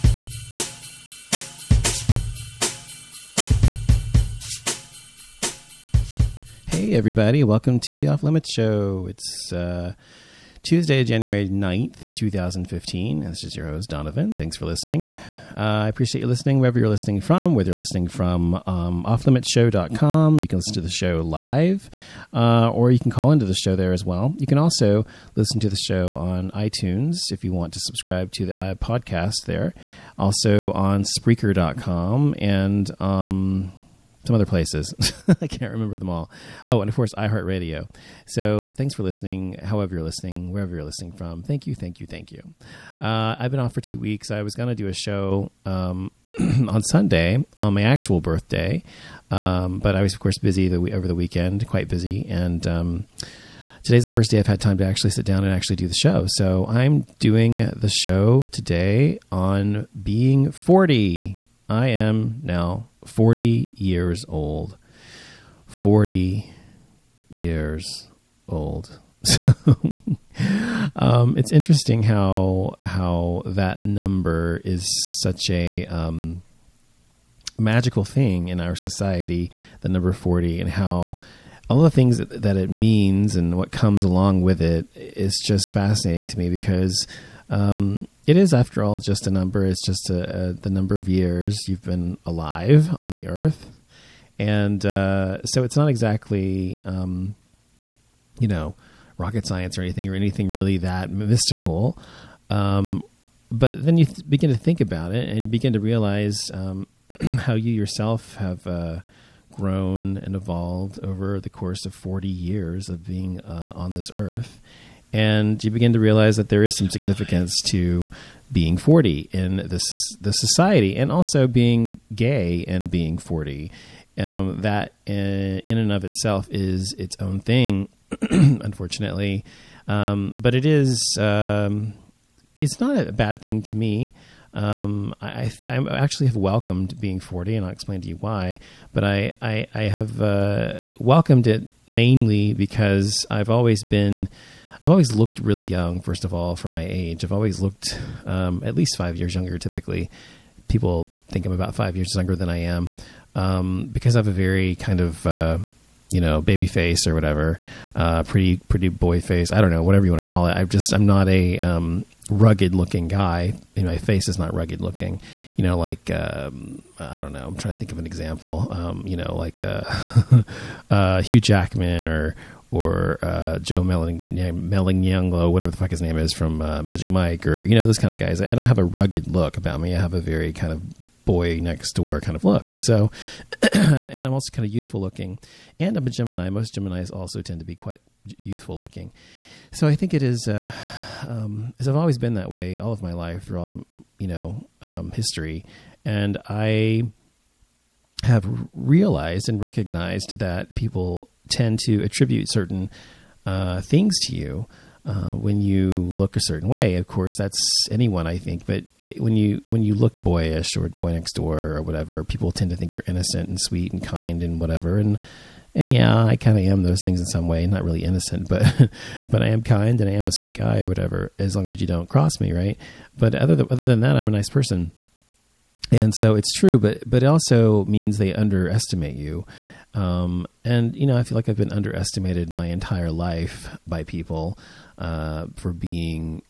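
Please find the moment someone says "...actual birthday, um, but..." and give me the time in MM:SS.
00:47.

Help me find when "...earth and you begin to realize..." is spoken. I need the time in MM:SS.
01:54.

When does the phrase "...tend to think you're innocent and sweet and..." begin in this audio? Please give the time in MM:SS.
03:32.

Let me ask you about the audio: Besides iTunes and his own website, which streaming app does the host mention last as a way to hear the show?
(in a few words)
iHeartRadio.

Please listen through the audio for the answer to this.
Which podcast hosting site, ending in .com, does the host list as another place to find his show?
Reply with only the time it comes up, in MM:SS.
00:31.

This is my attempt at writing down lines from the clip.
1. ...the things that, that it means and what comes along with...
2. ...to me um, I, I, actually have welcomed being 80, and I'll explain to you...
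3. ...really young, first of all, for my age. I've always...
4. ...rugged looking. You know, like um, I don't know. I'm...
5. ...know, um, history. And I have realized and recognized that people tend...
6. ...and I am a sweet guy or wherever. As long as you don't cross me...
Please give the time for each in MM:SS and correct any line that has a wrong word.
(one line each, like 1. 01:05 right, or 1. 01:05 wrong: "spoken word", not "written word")
1. 01:21 right
2. 02:13 wrong: "40", not "80"
3. 02:25 right
4. 02:44 right
5. 03:14 right
6. 03:40 wrong: "whatever", not "wherever".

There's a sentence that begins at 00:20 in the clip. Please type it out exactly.
You can listen to the show live, uh, or you can call into the show there as well.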